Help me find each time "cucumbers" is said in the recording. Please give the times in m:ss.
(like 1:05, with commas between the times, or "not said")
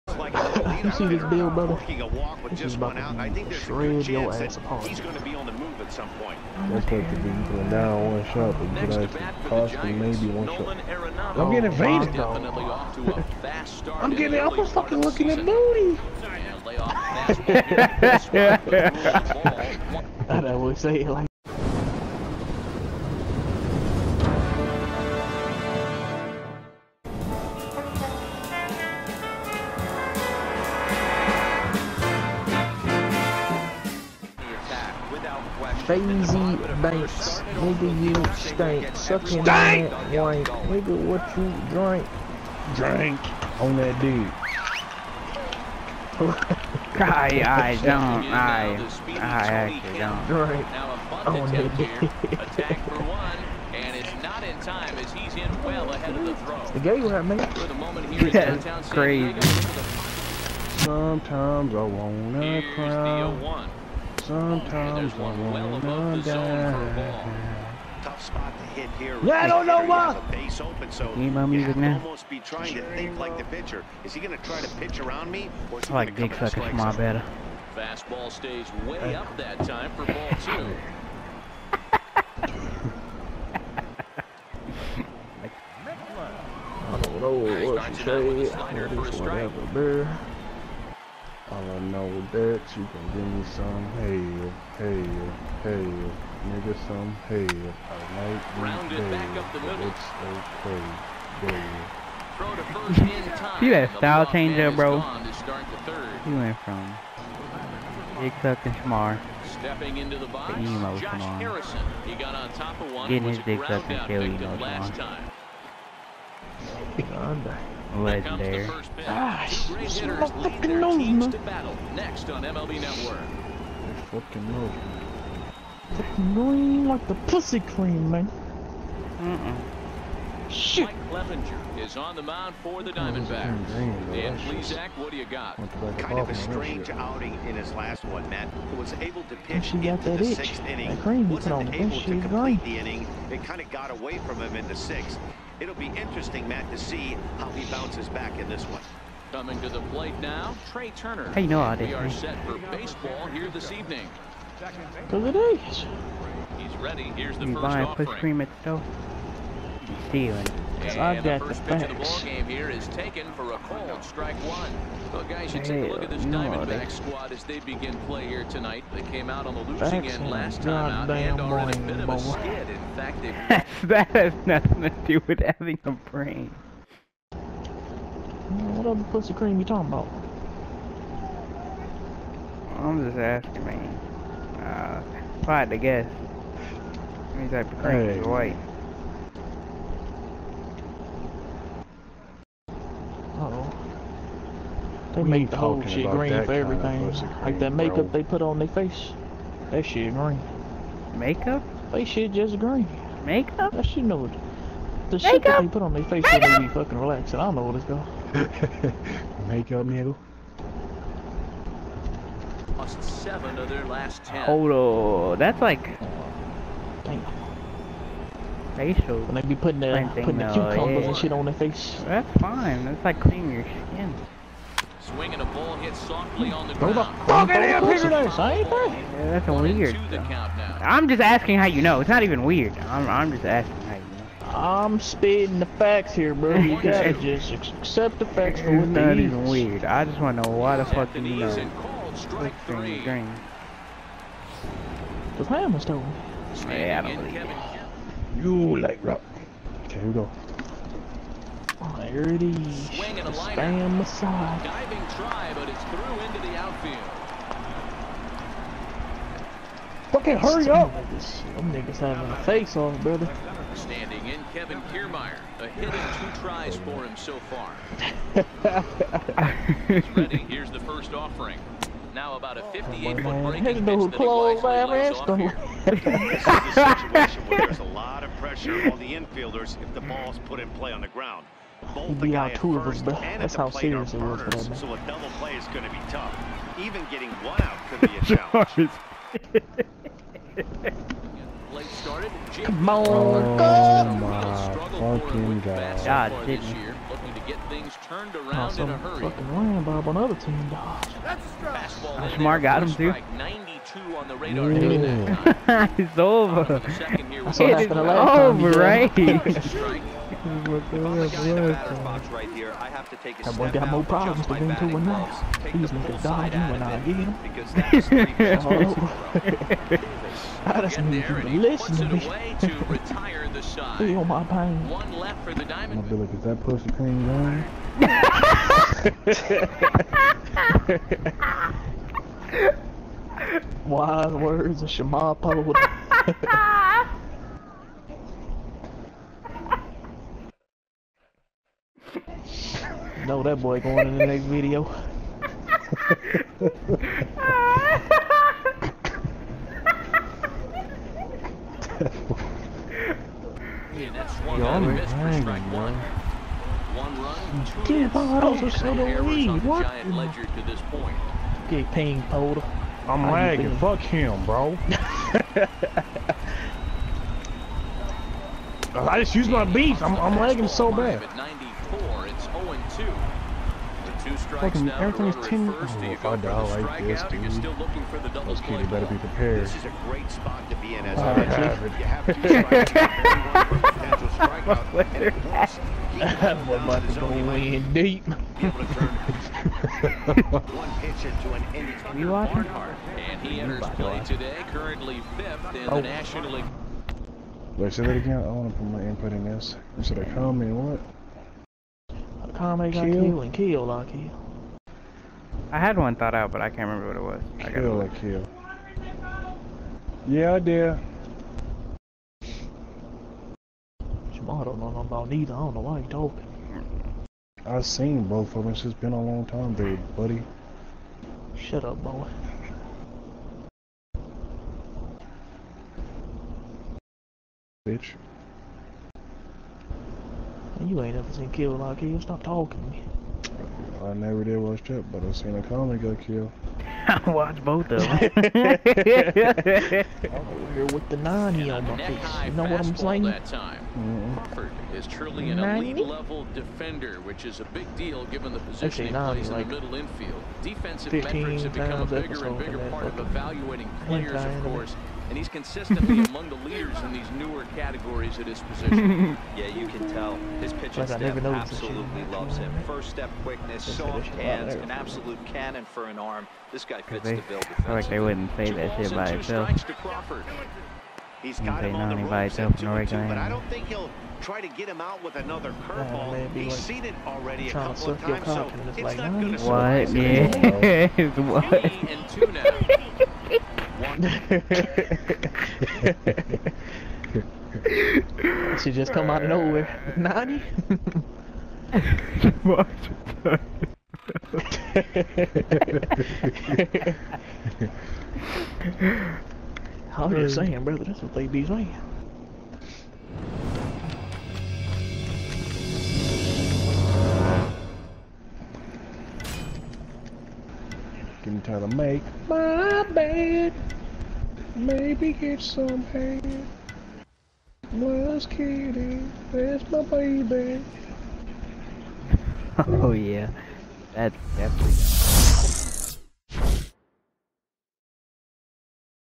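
3:40.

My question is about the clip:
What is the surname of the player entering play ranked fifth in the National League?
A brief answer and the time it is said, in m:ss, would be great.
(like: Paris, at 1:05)
Barnhart, at 6:32.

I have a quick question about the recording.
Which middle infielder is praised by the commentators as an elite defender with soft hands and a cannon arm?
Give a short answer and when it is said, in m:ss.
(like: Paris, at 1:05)
Crawford, at 7:24.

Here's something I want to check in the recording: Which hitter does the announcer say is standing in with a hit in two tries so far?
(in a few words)
Kevin Kiermaier.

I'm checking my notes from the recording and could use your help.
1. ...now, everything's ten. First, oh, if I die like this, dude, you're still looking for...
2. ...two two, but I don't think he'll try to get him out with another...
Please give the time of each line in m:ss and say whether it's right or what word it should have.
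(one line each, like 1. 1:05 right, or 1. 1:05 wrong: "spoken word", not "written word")
1. 6:14 right
2. 7:52 right.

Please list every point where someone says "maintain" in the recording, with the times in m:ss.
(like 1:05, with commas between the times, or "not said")
not said.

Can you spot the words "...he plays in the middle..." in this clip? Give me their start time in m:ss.
7:29.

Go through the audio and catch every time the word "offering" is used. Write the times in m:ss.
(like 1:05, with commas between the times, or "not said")
2:37, 4:31.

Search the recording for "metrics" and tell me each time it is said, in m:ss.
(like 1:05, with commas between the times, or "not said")
7:31.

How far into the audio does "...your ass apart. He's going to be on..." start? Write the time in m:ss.
0:04.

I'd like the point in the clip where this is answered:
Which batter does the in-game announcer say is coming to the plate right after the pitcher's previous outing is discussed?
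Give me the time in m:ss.
2:30.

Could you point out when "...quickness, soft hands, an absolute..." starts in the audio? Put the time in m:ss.
7:43.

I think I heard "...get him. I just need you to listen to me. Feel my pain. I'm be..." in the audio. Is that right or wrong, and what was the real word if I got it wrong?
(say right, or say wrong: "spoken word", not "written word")
right.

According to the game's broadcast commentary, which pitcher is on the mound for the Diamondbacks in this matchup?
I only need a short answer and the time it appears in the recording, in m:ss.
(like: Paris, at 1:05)
Mike Clevinger, at 2:10.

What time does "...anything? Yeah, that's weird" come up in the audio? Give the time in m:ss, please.
3:48.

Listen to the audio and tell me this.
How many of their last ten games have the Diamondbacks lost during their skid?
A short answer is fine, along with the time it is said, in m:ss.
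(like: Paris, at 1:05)
7, at 3:33.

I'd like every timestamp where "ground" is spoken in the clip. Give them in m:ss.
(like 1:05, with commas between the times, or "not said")
3:46, 4:41.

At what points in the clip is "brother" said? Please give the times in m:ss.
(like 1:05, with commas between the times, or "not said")
0:01, 4:23, 8:20.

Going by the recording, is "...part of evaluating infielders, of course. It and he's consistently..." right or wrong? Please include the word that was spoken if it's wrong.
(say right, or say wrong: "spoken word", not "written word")
wrong: "players", not "infielders".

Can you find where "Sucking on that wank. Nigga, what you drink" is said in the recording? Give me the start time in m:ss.
0:38.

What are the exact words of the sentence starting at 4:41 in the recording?
Both be out two of us, but that's how serious it was So a double play is going to be tough.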